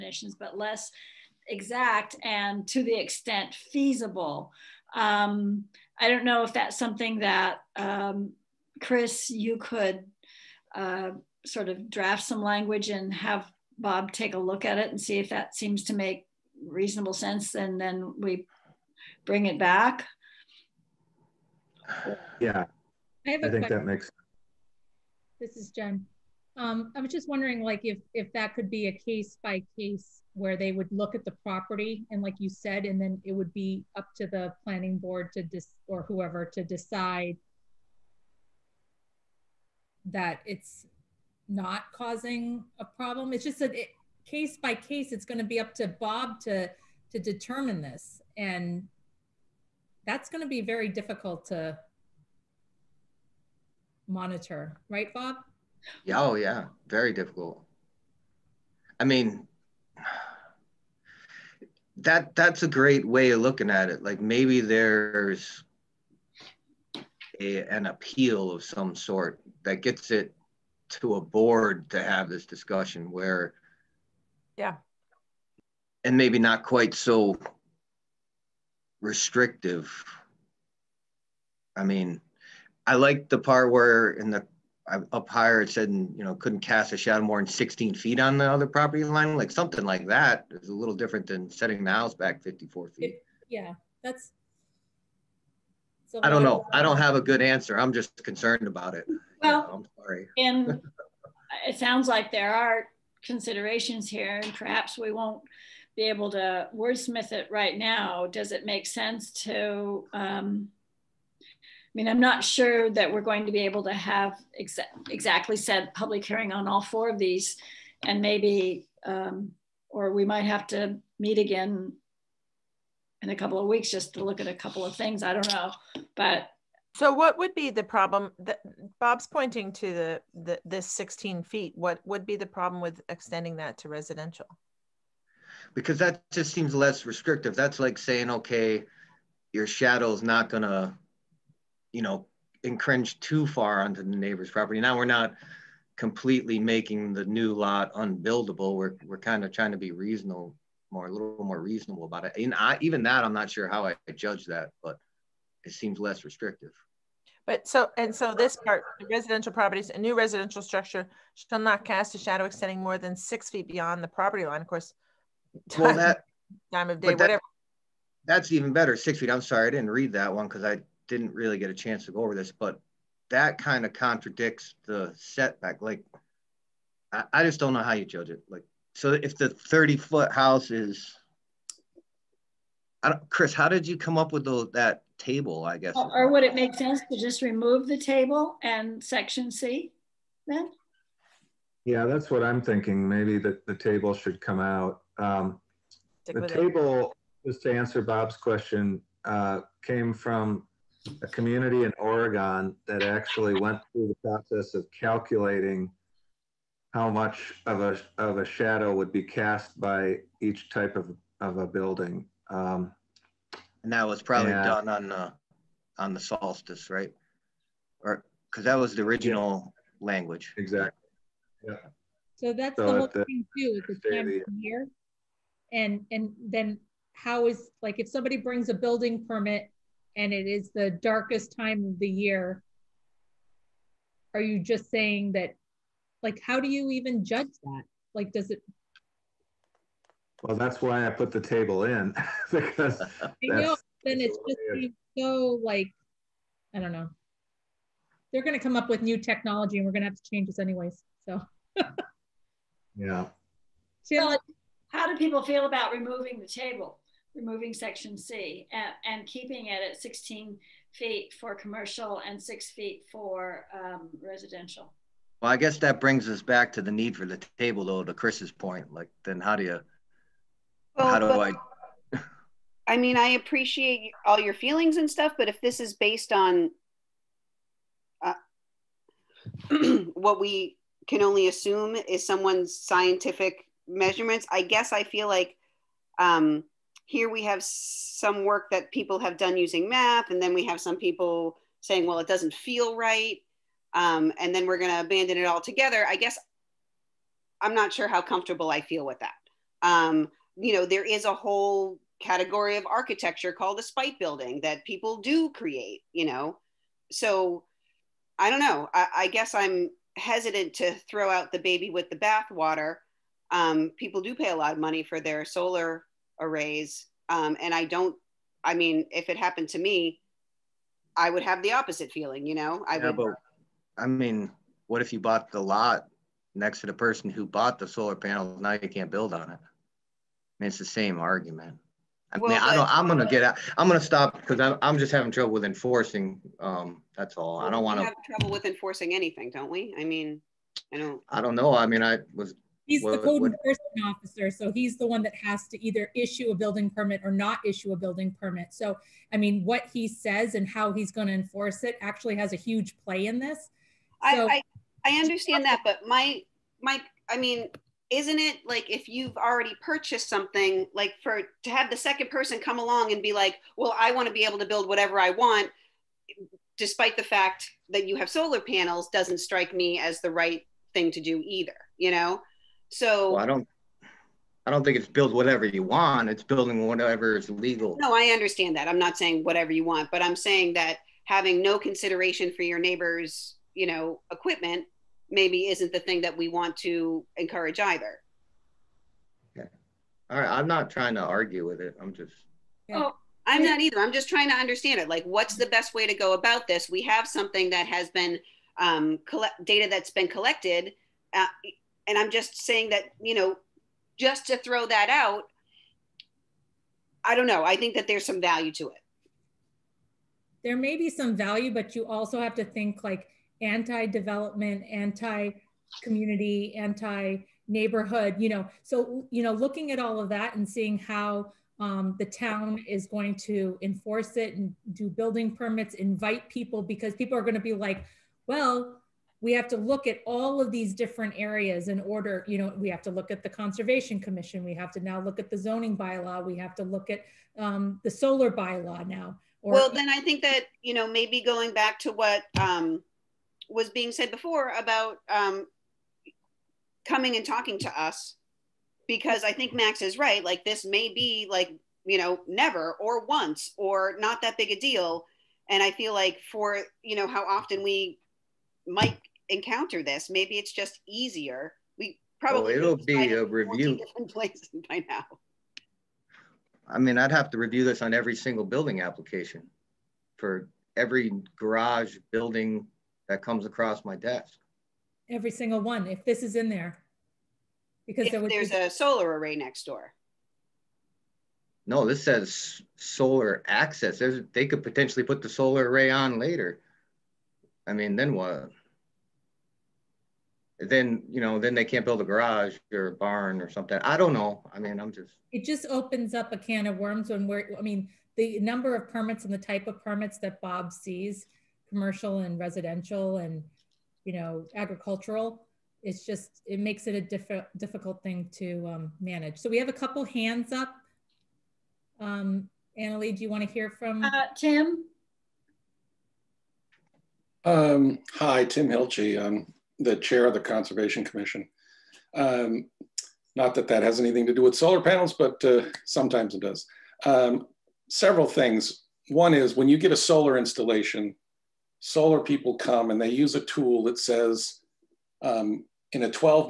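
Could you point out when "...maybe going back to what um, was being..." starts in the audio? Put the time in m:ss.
7:21.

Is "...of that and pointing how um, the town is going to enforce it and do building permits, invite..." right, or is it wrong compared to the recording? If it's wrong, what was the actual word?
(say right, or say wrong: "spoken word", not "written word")
wrong: "seeing", not "pointing".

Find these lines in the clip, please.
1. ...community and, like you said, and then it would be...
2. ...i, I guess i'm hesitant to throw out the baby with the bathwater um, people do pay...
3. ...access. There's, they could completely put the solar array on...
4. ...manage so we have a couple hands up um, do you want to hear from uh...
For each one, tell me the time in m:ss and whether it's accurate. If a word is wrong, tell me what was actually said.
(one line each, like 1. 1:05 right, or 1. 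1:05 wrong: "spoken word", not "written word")
1. 0:31 wrong: "property", not "community"
2. 5:08 right
3. 8:03 wrong: "potentially", not "completely"
4. 8:29 right.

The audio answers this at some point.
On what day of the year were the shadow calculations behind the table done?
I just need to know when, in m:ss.
3:36.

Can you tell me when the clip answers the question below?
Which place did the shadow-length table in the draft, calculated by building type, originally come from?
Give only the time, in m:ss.
3:21.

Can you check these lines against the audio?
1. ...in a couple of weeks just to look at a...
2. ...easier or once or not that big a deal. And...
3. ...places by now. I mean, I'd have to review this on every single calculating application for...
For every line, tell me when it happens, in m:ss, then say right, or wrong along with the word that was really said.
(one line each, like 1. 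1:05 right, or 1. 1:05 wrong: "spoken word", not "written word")
1. 2:03 right
2. 7:32 wrong: "never", not "easier"
3. 7:44 wrong: "building", not "calculating".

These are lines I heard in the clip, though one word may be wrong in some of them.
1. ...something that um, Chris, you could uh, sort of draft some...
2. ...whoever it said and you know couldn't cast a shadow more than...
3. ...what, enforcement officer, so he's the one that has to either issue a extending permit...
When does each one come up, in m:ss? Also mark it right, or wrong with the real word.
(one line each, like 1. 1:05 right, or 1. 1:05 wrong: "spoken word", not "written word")
1. 0:06 right
2. 1:25 wrong: "higher", not "whoever"
3. 5:43 wrong: "building", not "extending".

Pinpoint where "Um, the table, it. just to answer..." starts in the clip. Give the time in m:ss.
3:15.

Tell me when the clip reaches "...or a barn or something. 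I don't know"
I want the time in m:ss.
8:12.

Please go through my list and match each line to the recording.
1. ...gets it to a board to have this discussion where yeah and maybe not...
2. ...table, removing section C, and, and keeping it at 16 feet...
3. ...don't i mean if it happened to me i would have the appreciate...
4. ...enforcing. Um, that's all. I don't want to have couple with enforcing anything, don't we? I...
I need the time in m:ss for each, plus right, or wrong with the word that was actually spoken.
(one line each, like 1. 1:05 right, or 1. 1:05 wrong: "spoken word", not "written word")
1. 1:09 right
2. 4:16 right
3. 5:17 wrong: "opposite", not "appreciate"
4. 5:35 wrong: "trouble", not "couple".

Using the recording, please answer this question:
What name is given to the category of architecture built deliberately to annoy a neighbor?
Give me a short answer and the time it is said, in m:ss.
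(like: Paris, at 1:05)
spite building, at 5:03.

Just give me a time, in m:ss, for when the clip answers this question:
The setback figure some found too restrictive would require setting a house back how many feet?
1:32.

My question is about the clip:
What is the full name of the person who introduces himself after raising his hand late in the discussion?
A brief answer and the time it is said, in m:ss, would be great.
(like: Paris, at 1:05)
Tim Hilchey, at 8:38.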